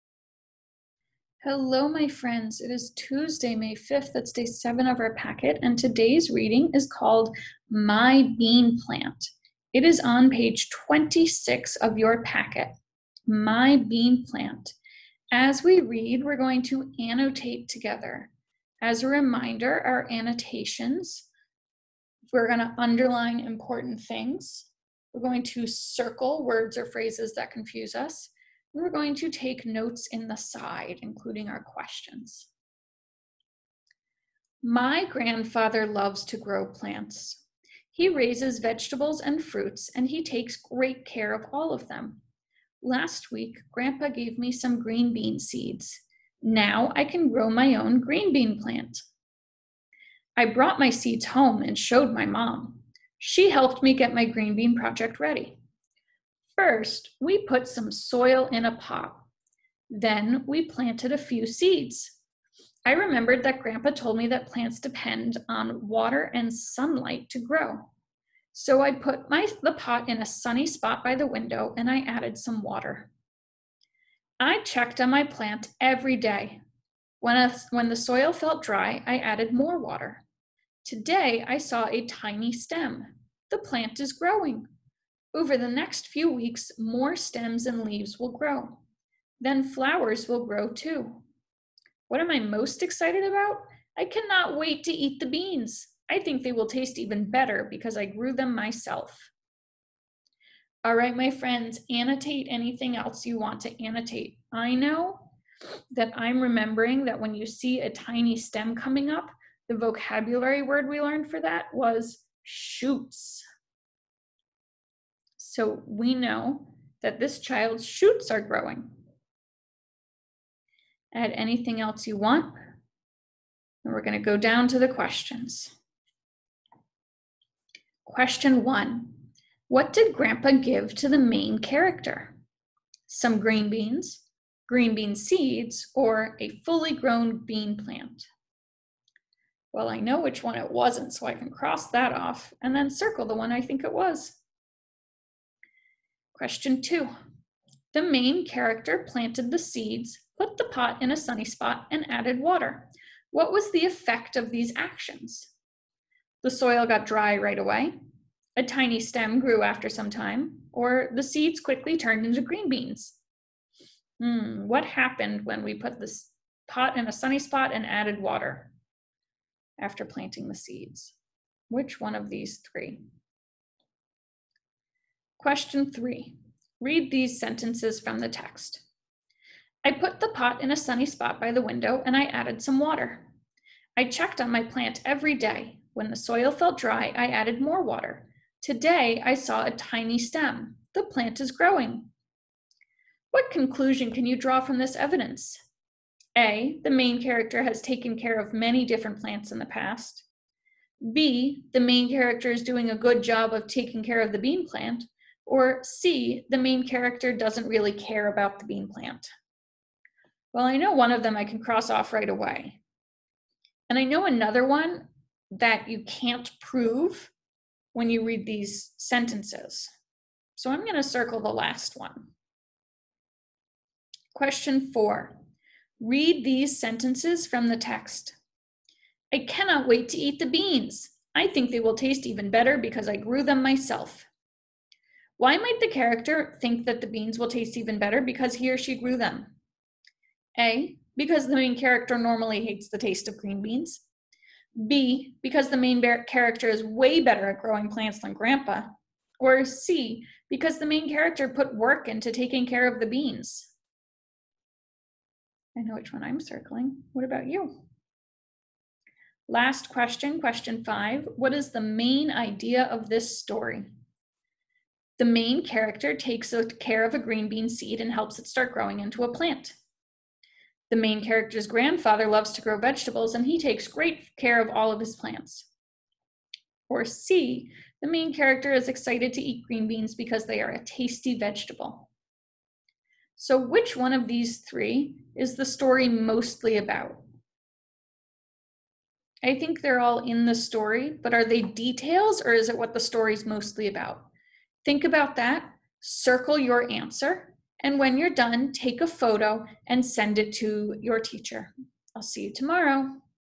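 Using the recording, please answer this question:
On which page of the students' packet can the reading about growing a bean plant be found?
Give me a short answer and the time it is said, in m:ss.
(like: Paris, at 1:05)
26, at 0:10.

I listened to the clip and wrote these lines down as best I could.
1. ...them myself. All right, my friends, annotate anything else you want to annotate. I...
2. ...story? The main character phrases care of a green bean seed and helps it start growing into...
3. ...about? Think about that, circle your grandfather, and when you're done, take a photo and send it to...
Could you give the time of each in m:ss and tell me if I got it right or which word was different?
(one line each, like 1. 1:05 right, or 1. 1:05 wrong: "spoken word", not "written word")
1. 1:38 right
2. 4:23 wrong: "takes", not "phrases"
3. 4:53 wrong: "answer", not "grandfather".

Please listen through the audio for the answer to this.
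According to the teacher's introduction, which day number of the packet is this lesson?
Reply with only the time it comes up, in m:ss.
0:04.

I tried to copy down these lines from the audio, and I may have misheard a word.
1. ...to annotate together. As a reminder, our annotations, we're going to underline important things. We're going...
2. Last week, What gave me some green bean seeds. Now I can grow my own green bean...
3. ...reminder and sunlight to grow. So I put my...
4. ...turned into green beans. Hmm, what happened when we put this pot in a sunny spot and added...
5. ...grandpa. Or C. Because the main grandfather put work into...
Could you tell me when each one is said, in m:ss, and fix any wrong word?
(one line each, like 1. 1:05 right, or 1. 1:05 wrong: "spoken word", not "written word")
1. 0:16 right
2. 0:42 wrong: "Grandpa", not "What"
3. 1:05 wrong: "water", not "reminder"
4. 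2:41 right
5. 4:08 wrong: "character", not "grandfather".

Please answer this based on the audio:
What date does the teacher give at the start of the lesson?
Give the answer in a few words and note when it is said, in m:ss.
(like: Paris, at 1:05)
Tuesday, May 5, at 0:02.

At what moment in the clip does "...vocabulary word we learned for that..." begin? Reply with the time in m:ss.
1:49.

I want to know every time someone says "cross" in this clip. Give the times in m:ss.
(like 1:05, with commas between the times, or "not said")
2:21, 3:31.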